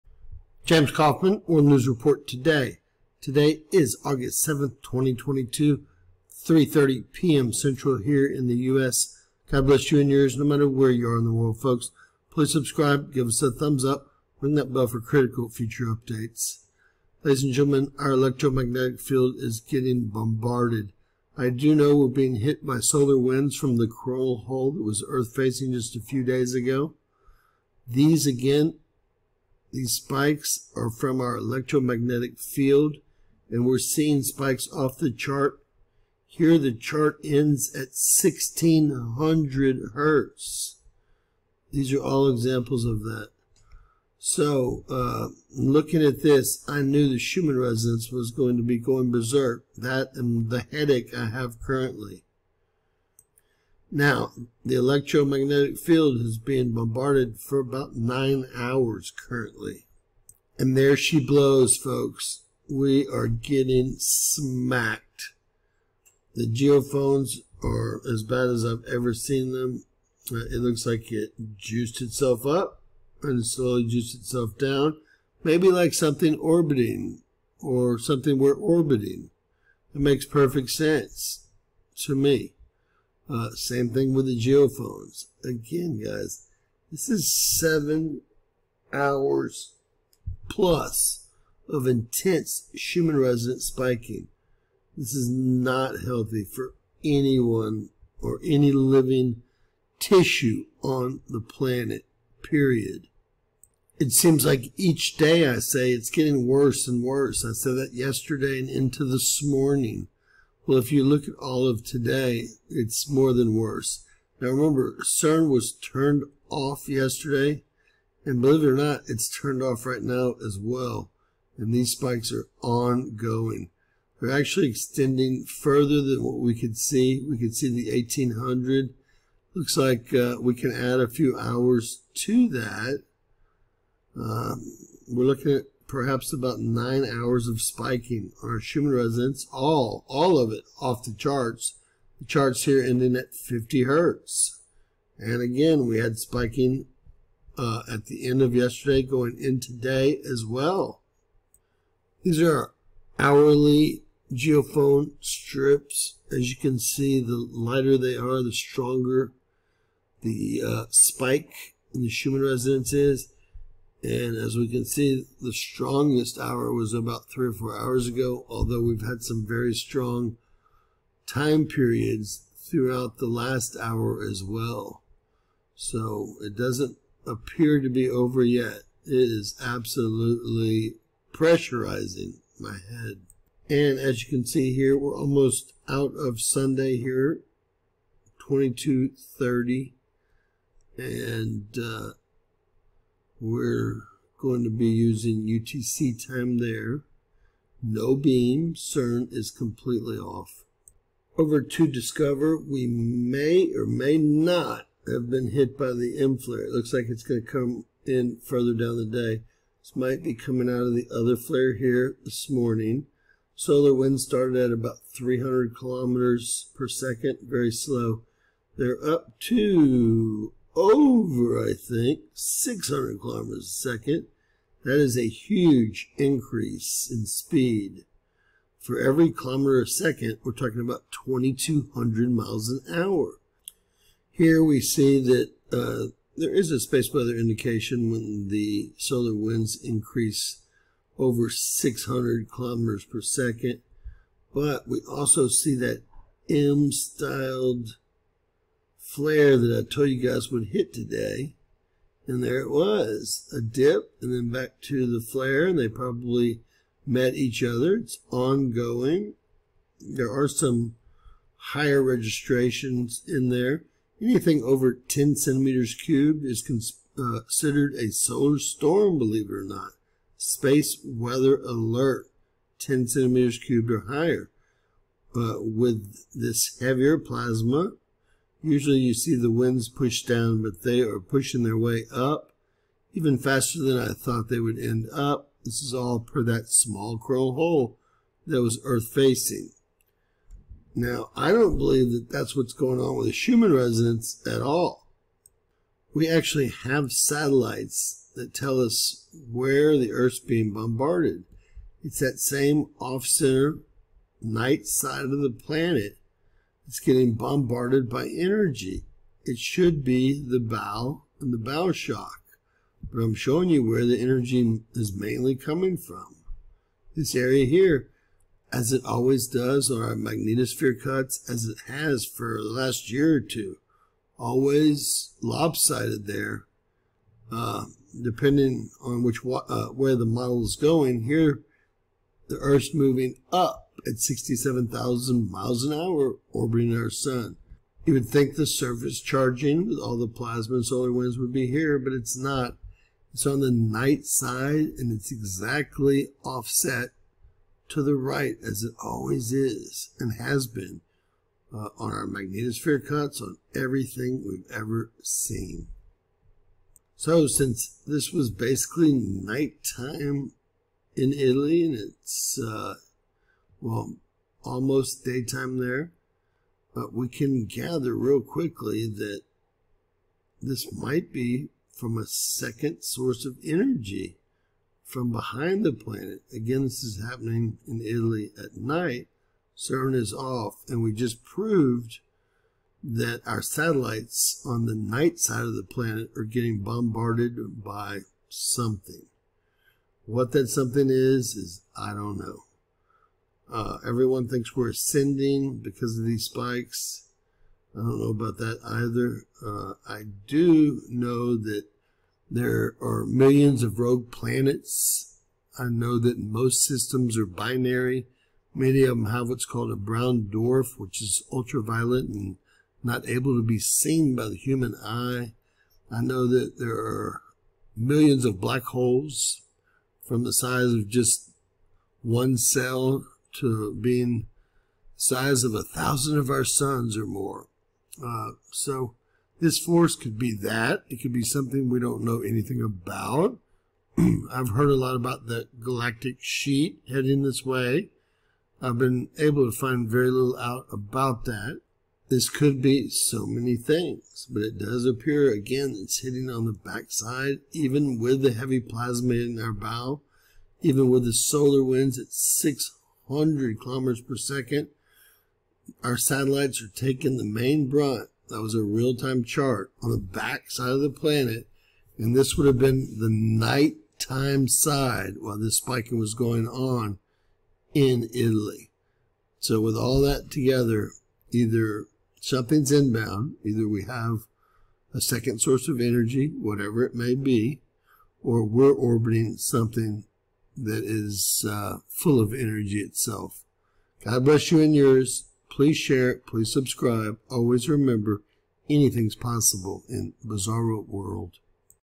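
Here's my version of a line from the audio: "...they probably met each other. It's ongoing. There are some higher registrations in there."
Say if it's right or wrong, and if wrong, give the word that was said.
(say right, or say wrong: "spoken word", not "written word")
right.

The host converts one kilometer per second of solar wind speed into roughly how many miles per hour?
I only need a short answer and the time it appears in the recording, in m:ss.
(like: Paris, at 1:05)
2,200, at 3:51.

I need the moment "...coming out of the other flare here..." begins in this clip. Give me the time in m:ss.
3:30.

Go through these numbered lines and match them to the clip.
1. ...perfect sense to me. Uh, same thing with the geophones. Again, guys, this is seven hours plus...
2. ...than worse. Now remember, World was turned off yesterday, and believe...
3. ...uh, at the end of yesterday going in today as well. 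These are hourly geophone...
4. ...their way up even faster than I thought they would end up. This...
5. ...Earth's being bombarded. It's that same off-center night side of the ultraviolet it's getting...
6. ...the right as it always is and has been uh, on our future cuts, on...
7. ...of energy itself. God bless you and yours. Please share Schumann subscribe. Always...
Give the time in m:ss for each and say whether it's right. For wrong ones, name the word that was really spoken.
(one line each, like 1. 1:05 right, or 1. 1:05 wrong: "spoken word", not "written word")
1. 1:20 right
2. 1:53 wrong: "CERN", not "World"
3. 2:27 right
4. 4:41 right
5. 5:00 wrong: "planet", not "ultraviolet"
6. 5:48 wrong: "magnetosphere", not "future"
7. 8:02 wrong: "Please", not "Schumann".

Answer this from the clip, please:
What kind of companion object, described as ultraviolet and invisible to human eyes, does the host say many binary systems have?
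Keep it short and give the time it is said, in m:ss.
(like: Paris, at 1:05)
brown dwarf, at 6:49.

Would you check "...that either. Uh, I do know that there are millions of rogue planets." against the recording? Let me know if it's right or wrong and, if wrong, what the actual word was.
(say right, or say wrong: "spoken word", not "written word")
right.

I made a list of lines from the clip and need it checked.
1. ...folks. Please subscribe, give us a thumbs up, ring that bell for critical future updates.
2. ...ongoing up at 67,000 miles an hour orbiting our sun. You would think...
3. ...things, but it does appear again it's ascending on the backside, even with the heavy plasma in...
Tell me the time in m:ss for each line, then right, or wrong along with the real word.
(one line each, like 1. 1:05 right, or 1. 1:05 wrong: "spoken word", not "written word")
1. 0:11 right
2. 5:32 wrong: "moving", not "ongoing"
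3. 7:23 wrong: "hitting", not "ascending".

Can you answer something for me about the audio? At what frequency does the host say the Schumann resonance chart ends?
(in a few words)
50 hertz.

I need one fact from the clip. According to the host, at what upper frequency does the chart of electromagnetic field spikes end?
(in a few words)
1600 hertz.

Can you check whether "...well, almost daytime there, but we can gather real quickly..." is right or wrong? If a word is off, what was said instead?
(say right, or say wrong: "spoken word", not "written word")
right.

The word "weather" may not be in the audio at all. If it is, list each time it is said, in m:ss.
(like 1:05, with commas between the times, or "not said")
3:57, 4:31.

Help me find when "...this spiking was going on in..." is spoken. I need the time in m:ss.
7:45.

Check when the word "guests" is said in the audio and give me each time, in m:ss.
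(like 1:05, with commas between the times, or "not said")
not said.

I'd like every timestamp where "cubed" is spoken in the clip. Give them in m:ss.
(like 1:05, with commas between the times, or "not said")
4:25, 4:33.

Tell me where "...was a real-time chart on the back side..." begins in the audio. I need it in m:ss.
7:38.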